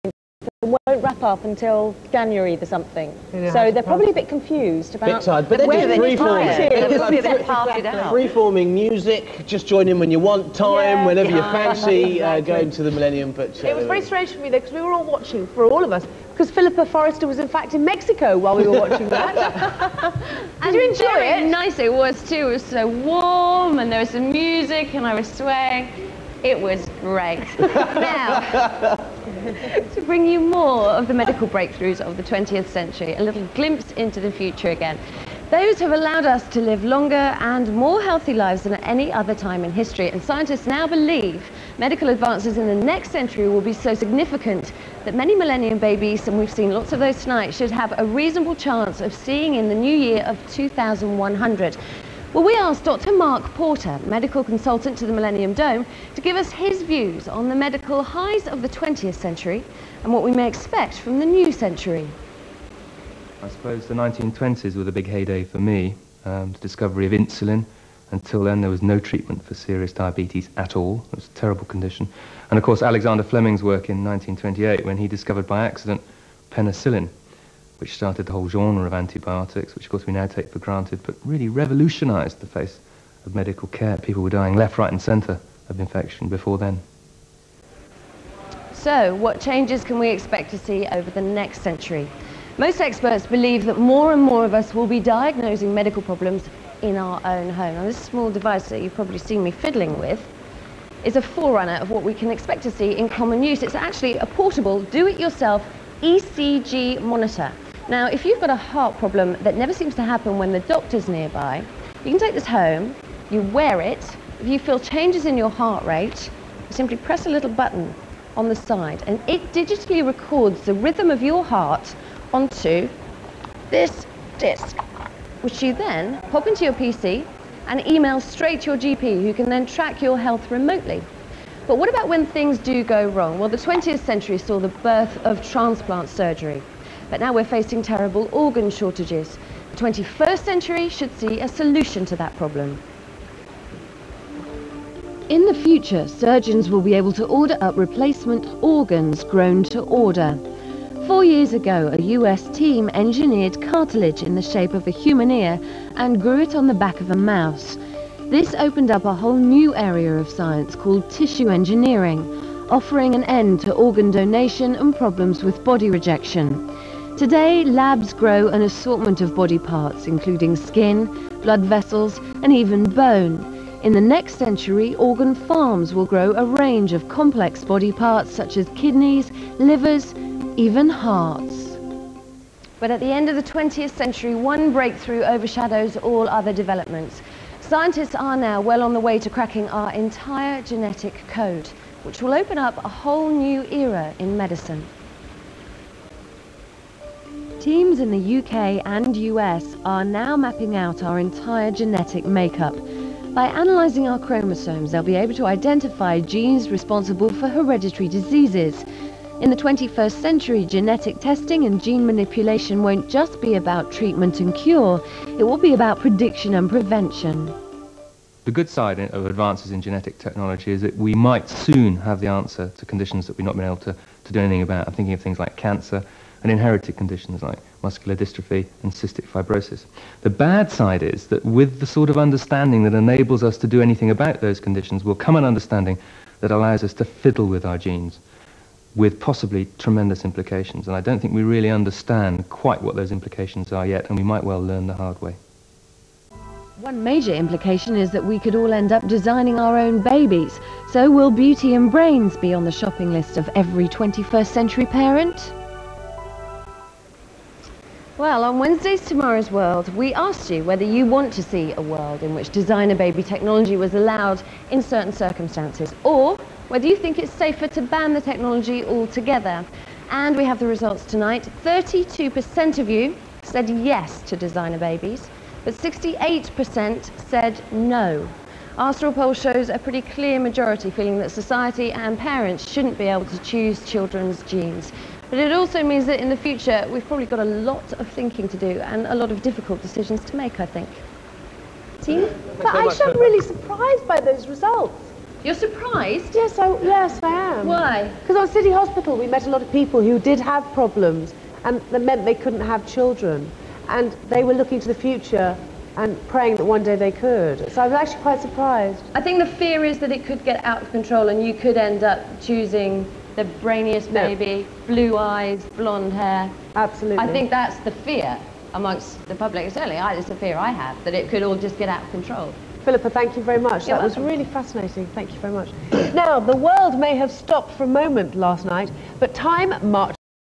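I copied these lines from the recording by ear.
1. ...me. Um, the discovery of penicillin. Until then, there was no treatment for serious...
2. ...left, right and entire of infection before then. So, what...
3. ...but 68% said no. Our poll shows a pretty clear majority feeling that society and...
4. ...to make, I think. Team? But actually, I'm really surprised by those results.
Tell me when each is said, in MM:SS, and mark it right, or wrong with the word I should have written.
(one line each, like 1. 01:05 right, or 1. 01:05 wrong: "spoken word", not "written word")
1. 01:05 wrong: "insulin", not "penicillin"
2. 01:24 wrong: "centre", not "entire"
3. 04:35 right
4. 04:50 right.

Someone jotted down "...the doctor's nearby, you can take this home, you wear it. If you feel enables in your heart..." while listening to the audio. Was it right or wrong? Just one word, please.
wrong.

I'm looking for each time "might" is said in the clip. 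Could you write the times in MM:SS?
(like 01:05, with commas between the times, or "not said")
03:41, 04:04.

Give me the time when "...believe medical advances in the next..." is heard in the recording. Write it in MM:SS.
00:40.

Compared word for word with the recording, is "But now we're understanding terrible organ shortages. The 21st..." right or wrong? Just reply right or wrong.
wrong.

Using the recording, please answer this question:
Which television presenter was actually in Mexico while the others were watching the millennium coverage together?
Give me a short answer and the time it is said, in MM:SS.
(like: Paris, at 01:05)
Philippa Forrester, at 00:16.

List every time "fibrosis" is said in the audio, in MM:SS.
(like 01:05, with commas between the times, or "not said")
03:49.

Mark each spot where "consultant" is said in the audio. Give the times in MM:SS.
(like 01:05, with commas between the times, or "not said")
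00:54.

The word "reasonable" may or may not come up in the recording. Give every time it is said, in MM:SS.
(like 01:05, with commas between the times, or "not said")
00:48.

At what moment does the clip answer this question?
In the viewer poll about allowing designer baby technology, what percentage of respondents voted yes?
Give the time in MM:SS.
04:31.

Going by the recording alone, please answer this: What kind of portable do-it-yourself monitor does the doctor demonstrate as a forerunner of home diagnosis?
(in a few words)
ECG monitor.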